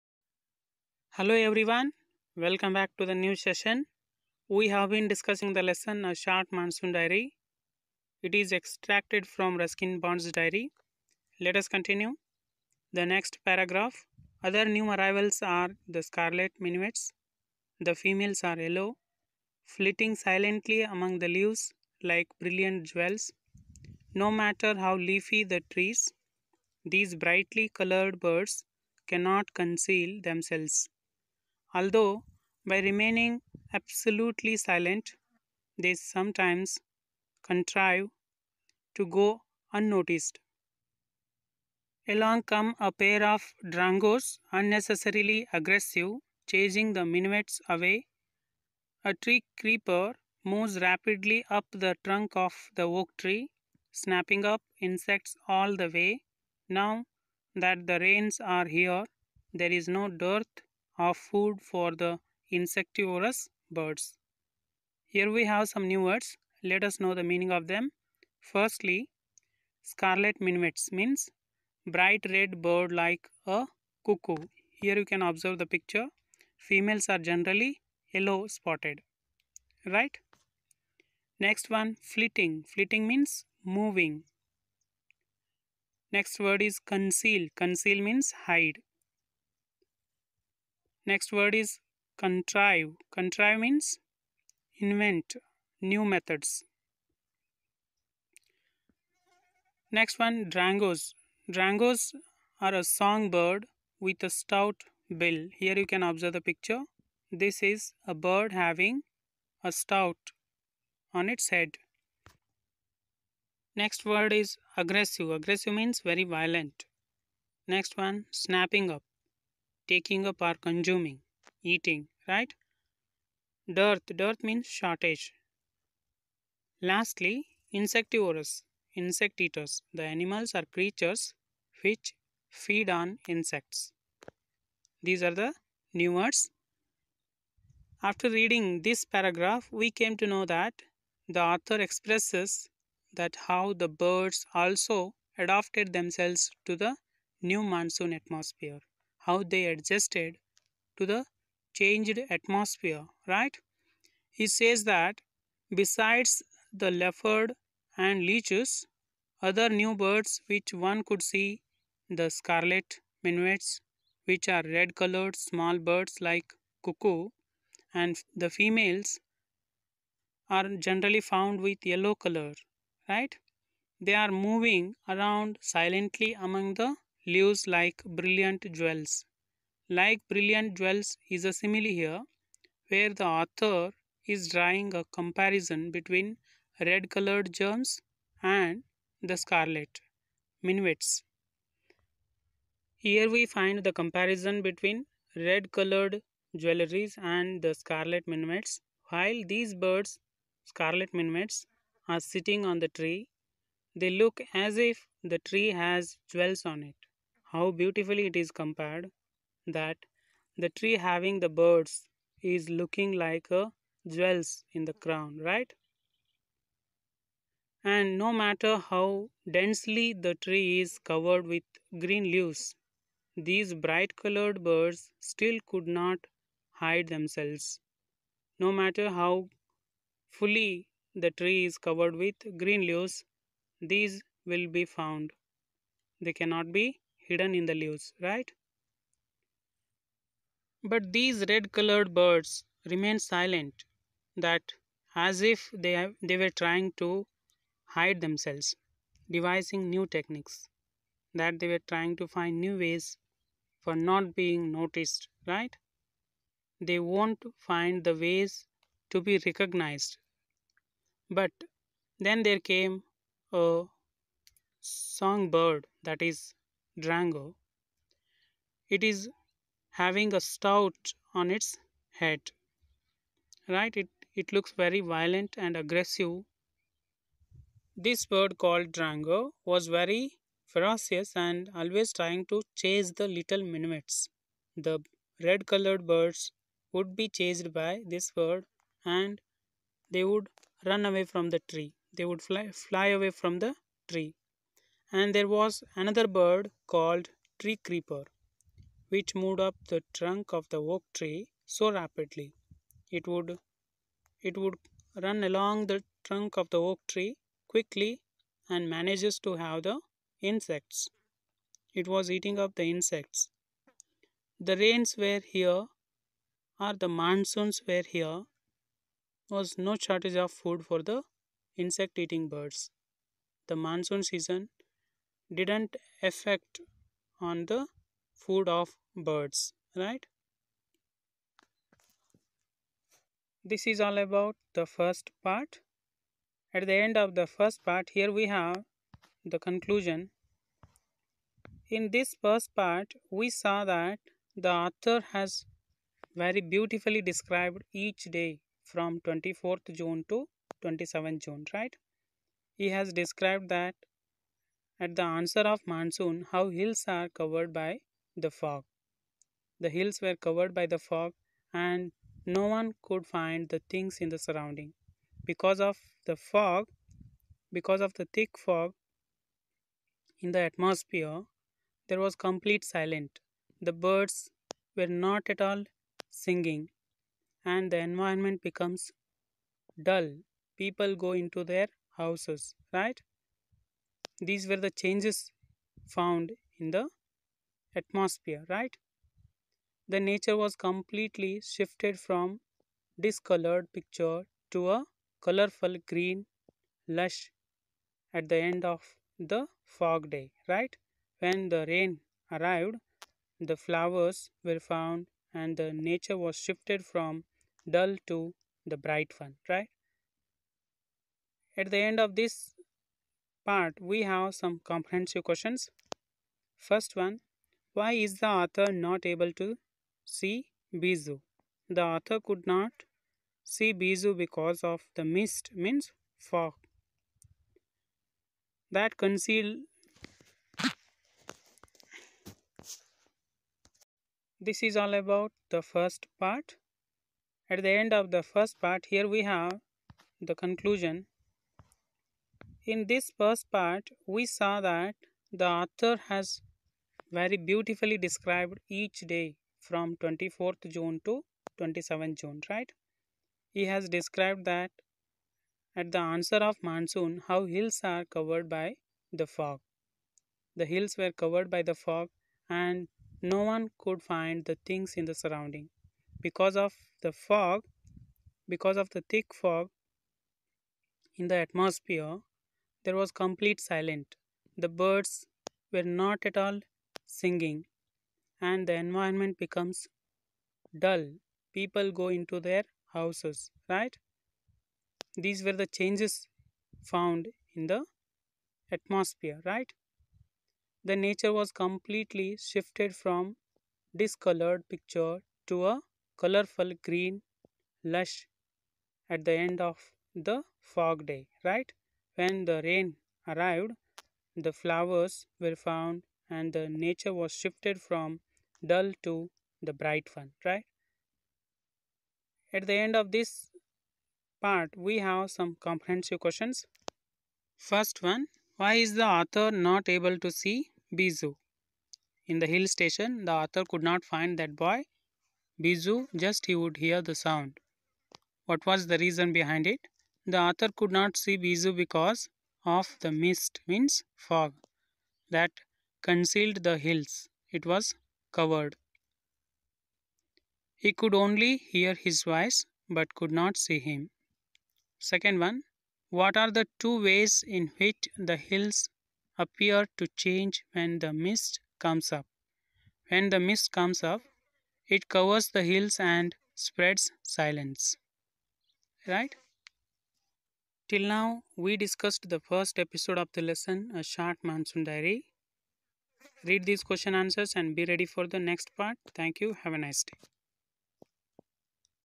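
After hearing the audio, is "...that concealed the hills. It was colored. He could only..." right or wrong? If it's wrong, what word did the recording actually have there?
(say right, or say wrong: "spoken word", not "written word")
wrong: "covered", not "colored".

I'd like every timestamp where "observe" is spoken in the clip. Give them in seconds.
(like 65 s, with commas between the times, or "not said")
75 s, 106 s.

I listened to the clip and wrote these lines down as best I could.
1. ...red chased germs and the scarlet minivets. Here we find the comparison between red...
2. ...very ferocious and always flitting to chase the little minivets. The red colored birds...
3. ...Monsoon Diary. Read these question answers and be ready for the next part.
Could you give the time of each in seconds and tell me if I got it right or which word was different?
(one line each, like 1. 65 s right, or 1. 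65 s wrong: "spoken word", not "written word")
1. 186 s wrong: "colored", not "chased"
2. 279 s wrong: "trying", not "flitting"
3. 564 s right.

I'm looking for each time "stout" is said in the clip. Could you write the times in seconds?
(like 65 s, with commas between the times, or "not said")
104 s, 109 s, 270 s.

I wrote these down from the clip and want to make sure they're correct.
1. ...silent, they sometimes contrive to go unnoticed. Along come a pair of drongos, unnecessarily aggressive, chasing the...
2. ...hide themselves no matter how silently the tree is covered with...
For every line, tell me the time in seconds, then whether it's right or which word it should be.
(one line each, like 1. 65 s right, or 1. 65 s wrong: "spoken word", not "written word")
1. 34 s right
2. 226 s wrong: "fully", not "silently".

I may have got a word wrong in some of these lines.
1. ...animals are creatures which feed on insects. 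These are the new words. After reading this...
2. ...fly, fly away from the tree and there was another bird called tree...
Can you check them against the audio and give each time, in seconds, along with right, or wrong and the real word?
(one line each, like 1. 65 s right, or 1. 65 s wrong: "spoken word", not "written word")
1. 130 s right
2. 292 s right.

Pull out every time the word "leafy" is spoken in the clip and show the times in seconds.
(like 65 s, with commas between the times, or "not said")
24 s.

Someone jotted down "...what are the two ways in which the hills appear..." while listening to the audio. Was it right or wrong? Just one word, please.
right.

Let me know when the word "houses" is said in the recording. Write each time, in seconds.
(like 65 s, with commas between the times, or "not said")
382 s, 483 s.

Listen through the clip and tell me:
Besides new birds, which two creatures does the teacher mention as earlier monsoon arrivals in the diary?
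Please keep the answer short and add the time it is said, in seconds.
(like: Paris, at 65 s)
Leopard and leeches, at 156 s.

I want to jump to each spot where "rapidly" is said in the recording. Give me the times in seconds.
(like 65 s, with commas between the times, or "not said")
50 s, 301 s.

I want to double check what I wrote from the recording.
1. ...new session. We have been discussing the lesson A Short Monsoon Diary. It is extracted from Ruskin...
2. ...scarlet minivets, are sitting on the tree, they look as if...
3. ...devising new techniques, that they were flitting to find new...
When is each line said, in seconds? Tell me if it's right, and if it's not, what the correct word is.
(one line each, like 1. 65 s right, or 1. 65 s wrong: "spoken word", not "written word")
1. 3 s right
2. 200 s right
3. 249 s wrong: "trying", not "flitting".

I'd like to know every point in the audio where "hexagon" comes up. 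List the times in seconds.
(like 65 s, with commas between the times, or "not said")
not said.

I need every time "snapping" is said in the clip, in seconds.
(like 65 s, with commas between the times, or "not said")
53 s, 118 s.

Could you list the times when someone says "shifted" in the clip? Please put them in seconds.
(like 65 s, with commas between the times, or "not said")
391 s, 406 s, 492 s, 507 s.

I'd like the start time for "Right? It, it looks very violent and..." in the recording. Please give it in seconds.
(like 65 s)
273 s.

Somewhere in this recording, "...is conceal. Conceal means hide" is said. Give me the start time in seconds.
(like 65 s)
86 s.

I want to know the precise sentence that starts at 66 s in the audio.
Let us know the meaning of them.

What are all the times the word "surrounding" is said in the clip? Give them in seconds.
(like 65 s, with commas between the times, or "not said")
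364 s, 465 s.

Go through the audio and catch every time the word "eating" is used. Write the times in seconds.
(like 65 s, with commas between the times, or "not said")
121 s, 312 s, 322 s.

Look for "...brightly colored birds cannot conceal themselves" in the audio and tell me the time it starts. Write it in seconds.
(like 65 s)
27 s.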